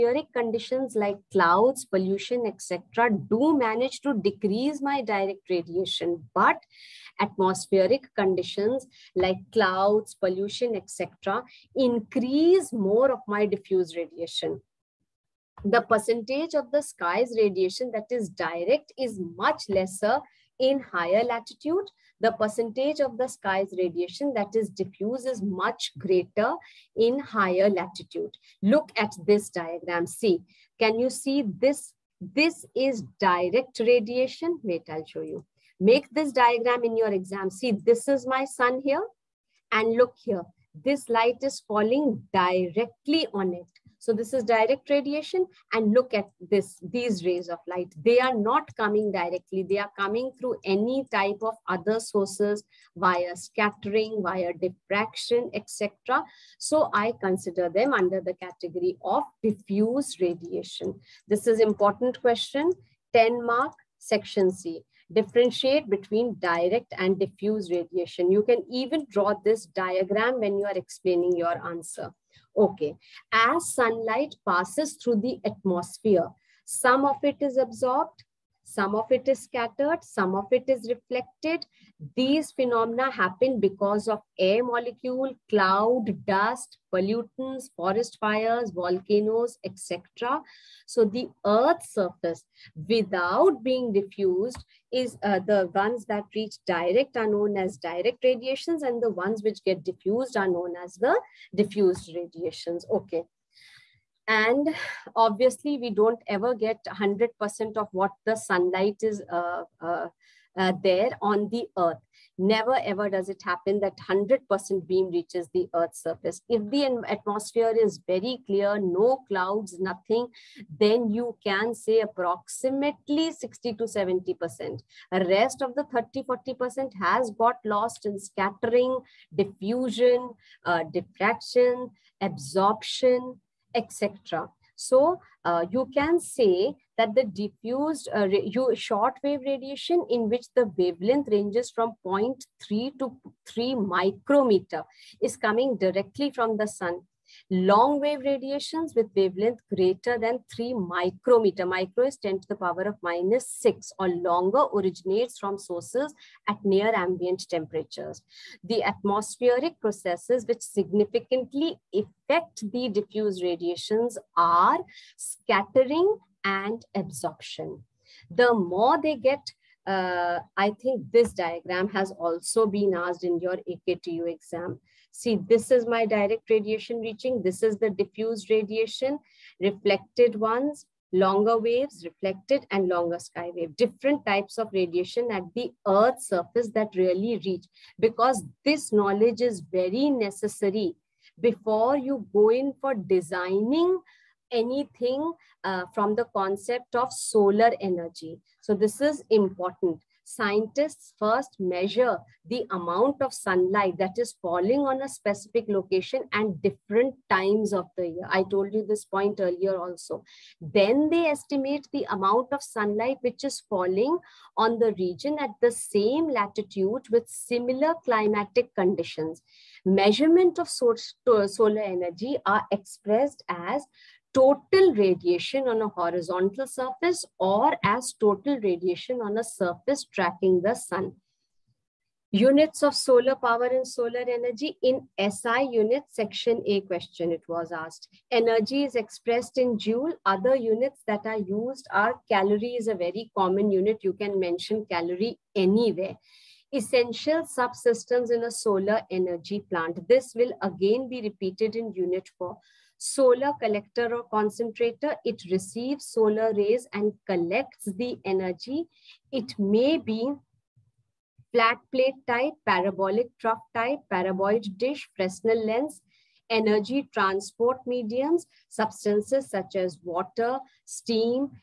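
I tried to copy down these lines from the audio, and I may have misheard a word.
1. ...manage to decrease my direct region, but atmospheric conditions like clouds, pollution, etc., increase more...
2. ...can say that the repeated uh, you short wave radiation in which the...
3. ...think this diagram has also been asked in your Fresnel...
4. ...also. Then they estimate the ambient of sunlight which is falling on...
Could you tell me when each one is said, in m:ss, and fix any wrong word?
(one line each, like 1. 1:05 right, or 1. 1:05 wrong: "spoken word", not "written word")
1. 0:03 wrong: "radiation", not "region"
2. 2:15 wrong: "diffused", not "repeated"
3. 2:50 wrong: "AKTU", not "Fresnel"
4. 3:29 wrong: "amount", not "ambient".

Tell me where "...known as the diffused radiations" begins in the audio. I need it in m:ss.
1:40.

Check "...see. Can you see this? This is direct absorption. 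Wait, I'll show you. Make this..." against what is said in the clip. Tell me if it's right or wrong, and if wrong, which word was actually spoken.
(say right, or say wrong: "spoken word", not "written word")
wrong: "radiation", not "absorption".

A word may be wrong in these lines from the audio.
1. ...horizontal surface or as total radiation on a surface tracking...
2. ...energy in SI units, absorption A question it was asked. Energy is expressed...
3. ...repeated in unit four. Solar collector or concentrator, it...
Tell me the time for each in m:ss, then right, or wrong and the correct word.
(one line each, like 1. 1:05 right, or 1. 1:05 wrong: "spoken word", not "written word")
1. 3:45 right
2. 3:54 wrong: "section", not "absorption"
3. 4:11 right.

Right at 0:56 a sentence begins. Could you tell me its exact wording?
So I consider them under the category of diffuse radiation.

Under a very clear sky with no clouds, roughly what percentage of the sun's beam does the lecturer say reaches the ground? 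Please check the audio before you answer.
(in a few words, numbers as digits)
60 to 70%.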